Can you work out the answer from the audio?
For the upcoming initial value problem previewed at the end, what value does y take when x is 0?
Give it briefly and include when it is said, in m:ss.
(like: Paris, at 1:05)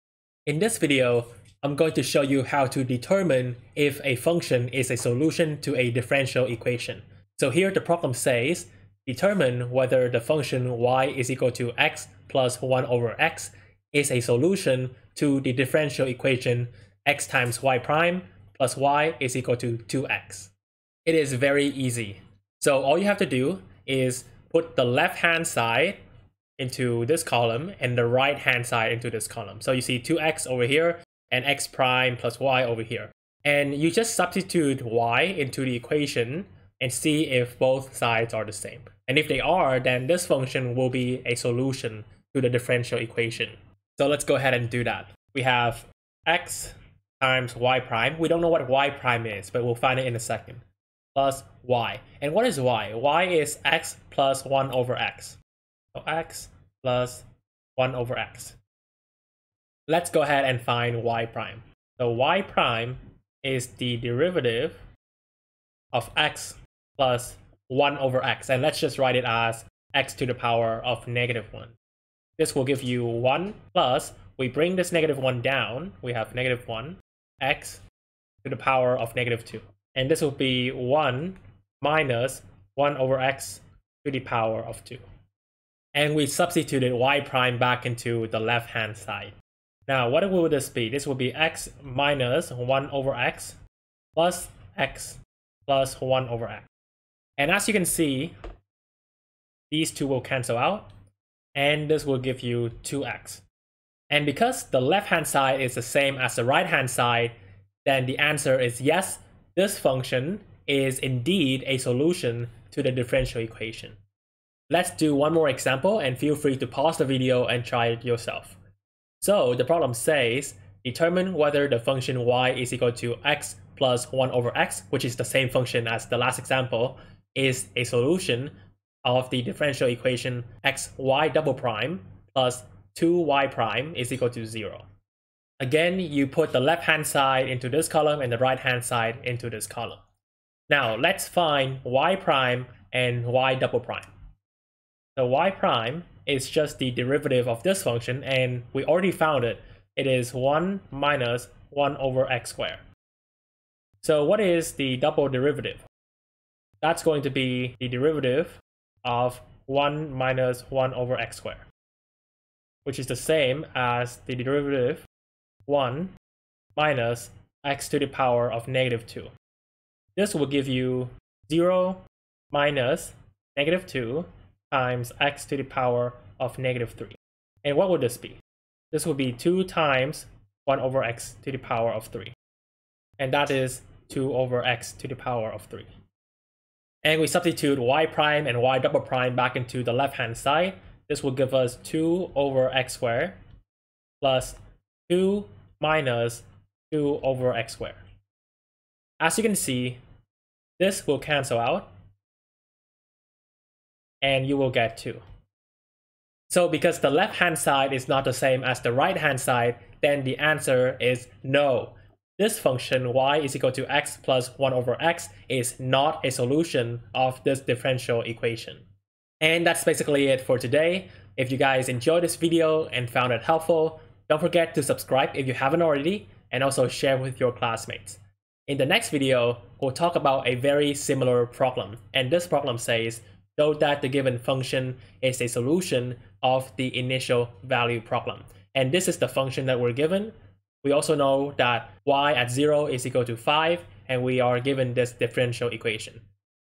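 5, at 4:03.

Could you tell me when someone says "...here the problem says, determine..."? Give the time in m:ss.
0:07.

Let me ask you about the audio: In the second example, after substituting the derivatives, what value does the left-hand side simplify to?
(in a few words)
2.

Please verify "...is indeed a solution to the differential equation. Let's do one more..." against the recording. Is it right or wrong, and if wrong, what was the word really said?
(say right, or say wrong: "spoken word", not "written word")
right.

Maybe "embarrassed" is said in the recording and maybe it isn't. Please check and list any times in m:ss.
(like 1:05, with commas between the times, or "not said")
not said.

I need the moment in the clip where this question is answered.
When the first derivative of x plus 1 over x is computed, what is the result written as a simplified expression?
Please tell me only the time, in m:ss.
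1:20.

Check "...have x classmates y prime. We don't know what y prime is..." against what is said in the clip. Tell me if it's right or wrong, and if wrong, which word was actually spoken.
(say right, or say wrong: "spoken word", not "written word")
wrong: "times", not "classmates".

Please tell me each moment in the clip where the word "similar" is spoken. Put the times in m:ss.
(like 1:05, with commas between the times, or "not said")
3:50.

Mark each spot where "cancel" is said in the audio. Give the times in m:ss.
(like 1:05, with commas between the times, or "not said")
1:40, 3:21.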